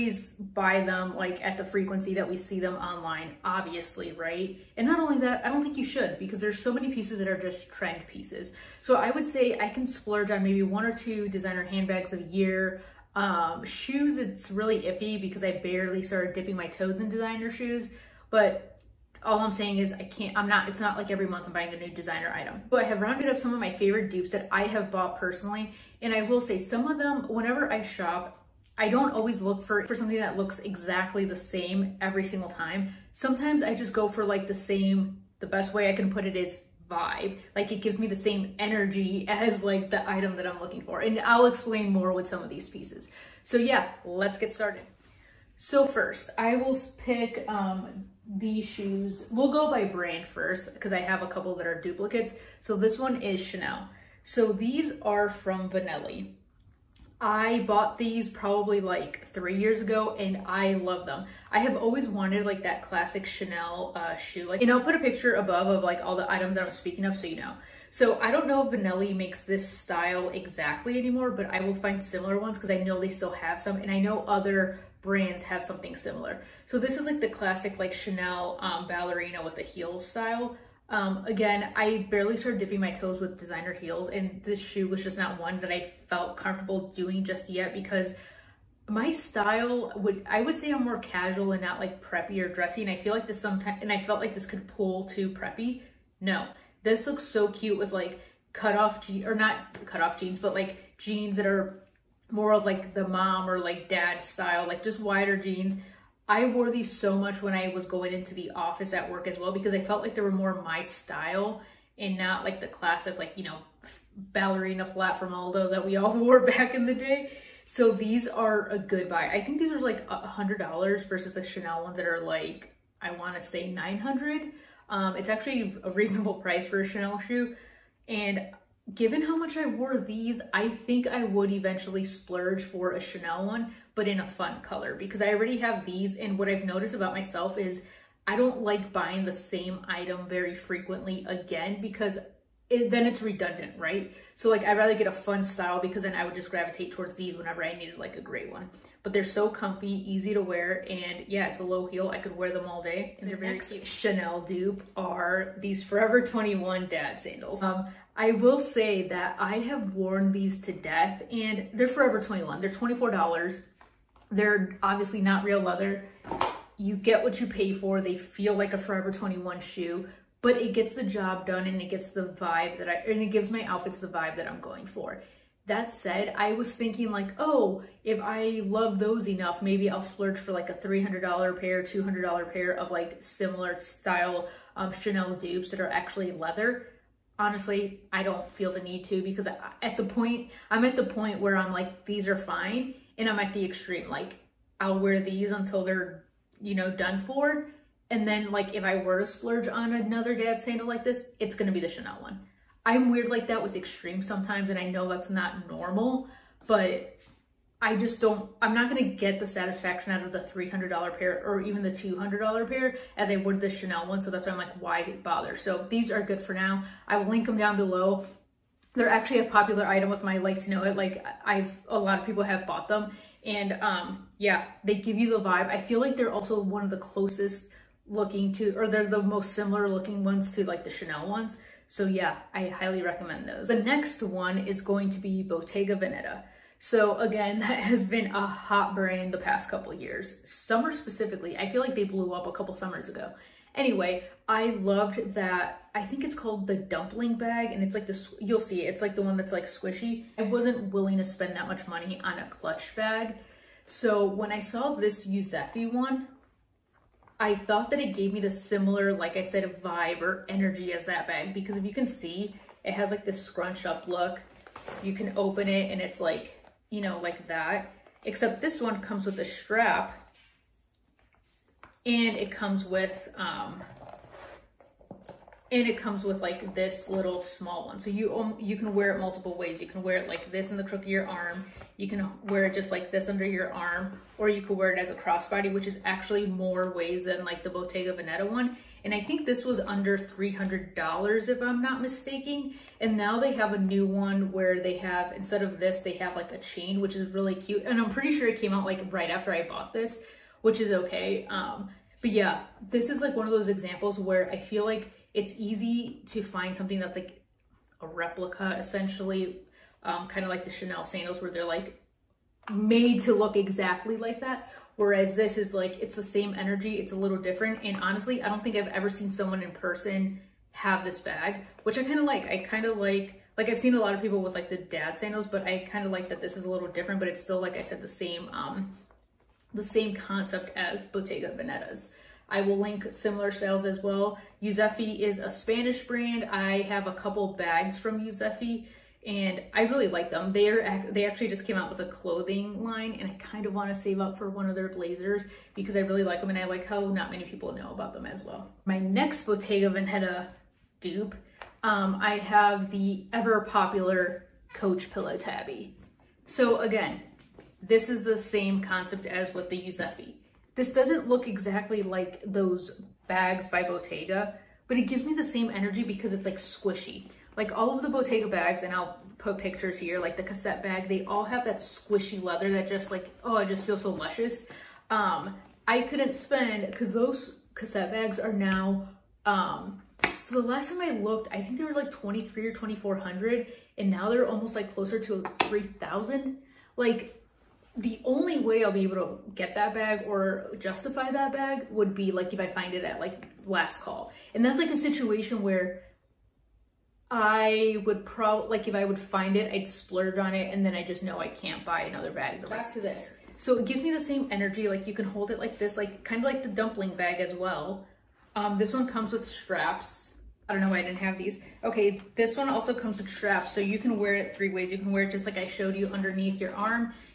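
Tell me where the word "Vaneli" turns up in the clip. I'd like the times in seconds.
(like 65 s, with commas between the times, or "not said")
55 s, 68 s.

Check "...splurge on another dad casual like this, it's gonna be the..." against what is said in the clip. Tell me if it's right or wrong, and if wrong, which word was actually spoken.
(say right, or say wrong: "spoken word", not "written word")
wrong: "sandal", not "casual".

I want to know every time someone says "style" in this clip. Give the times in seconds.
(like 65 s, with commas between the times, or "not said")
69 s, 79 s, 89 s, 104 s, 110 s, 145 s, 183 s.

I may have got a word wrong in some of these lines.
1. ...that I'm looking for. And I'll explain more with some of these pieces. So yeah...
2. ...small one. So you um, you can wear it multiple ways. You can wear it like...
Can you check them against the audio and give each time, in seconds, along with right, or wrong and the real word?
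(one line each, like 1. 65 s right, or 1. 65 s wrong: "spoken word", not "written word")
1. 40 s right
2. 277 s right.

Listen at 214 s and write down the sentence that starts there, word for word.
So that's why I'm like, why bother?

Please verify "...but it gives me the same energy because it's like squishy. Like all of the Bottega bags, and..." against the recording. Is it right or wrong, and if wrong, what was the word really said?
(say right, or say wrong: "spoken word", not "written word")
right.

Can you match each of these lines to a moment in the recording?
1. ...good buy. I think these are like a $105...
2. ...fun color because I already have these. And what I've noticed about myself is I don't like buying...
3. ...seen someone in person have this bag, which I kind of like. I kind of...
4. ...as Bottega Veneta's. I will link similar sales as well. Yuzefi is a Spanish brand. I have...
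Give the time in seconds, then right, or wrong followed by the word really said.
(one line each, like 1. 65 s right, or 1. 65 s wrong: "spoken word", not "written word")
1. 118 s wrong: "100", not "105"
2. 134 s right
3. 319 s right
4. 330 s right.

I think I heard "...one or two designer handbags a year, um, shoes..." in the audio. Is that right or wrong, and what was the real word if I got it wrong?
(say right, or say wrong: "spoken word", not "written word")
right.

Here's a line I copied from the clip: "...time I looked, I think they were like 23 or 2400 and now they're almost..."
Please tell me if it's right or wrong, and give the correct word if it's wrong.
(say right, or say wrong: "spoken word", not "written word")
right.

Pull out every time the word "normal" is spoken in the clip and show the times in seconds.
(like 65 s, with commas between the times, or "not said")
205 s.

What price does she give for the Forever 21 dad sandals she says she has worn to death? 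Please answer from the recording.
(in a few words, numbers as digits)
$24.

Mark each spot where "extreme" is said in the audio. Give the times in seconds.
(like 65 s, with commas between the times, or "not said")
193 s, 203 s.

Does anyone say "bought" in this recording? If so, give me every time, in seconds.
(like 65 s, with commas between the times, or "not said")
24 s, 57 s, 222 s, 299 s.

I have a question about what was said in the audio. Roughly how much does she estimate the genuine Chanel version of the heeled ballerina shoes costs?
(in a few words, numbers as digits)
900.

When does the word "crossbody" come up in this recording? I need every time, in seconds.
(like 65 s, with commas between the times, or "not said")
285 s.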